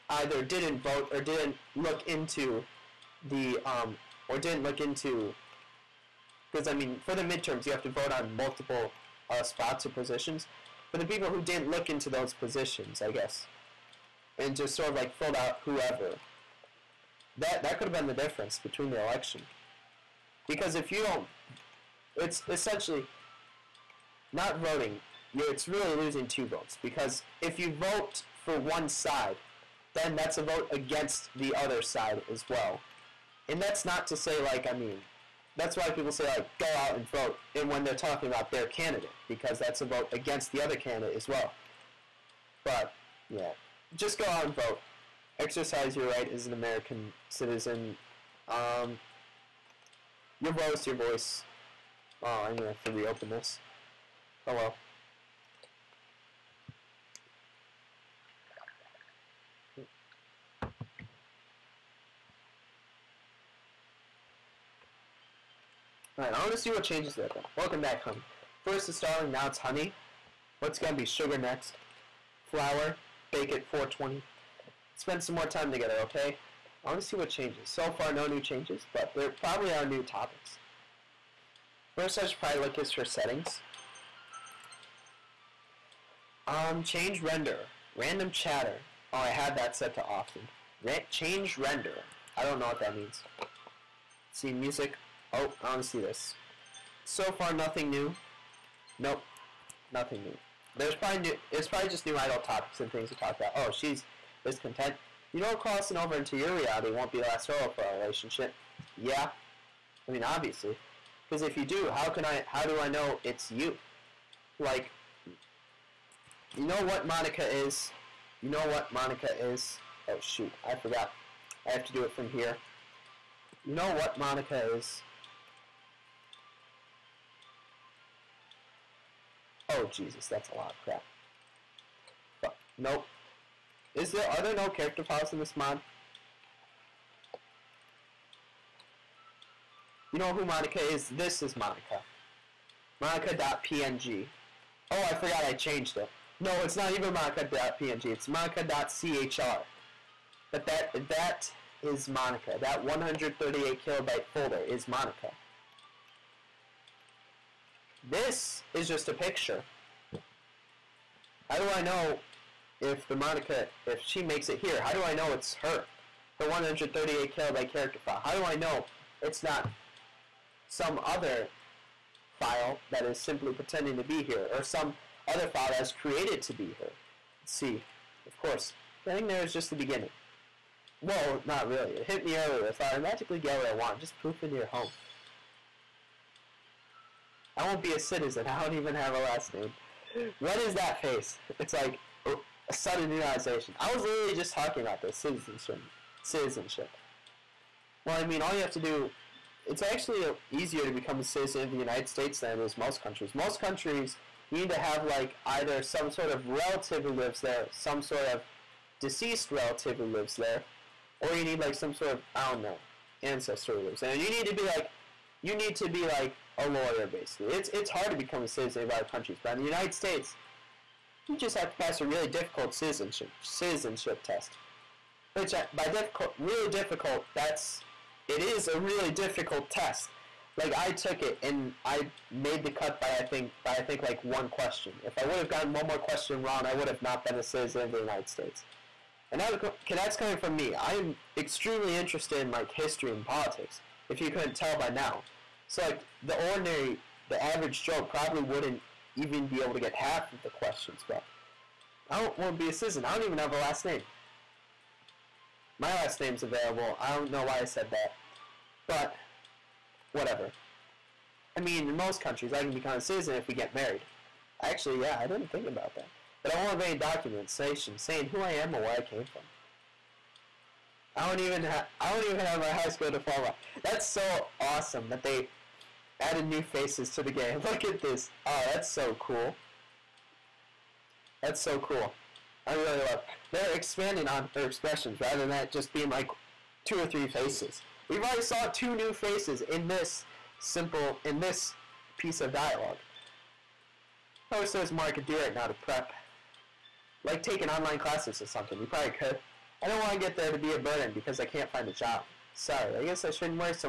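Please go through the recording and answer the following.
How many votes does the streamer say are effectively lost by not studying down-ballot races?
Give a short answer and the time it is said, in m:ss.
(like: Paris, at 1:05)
2, at 0:26.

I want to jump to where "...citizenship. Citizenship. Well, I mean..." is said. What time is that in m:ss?
3:15.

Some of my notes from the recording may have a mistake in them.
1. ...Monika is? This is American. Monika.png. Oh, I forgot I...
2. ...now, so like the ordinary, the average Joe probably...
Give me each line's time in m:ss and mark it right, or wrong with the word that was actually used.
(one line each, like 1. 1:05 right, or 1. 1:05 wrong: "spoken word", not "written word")
1. 2:20 wrong: "Monika", not "American"
2. 4:04 right.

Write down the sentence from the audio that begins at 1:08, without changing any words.
First it's darling, now it's honey.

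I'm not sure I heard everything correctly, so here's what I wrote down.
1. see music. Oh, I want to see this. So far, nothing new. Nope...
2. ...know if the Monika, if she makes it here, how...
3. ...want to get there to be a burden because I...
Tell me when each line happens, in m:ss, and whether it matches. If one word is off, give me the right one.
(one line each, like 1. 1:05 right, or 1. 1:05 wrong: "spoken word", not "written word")
1. 1:34 right
2. 2:41 right
3. 4:59 right.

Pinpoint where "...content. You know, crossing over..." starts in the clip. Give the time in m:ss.
1:44.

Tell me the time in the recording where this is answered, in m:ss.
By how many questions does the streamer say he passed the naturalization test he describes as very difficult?
3:54.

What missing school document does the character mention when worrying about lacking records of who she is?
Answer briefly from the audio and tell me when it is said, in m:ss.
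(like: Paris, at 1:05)
high school diploma, at 4:32.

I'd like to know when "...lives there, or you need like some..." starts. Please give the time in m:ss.
3:30.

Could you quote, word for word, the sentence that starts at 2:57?
Let's see, of course, getting there is just the beginning.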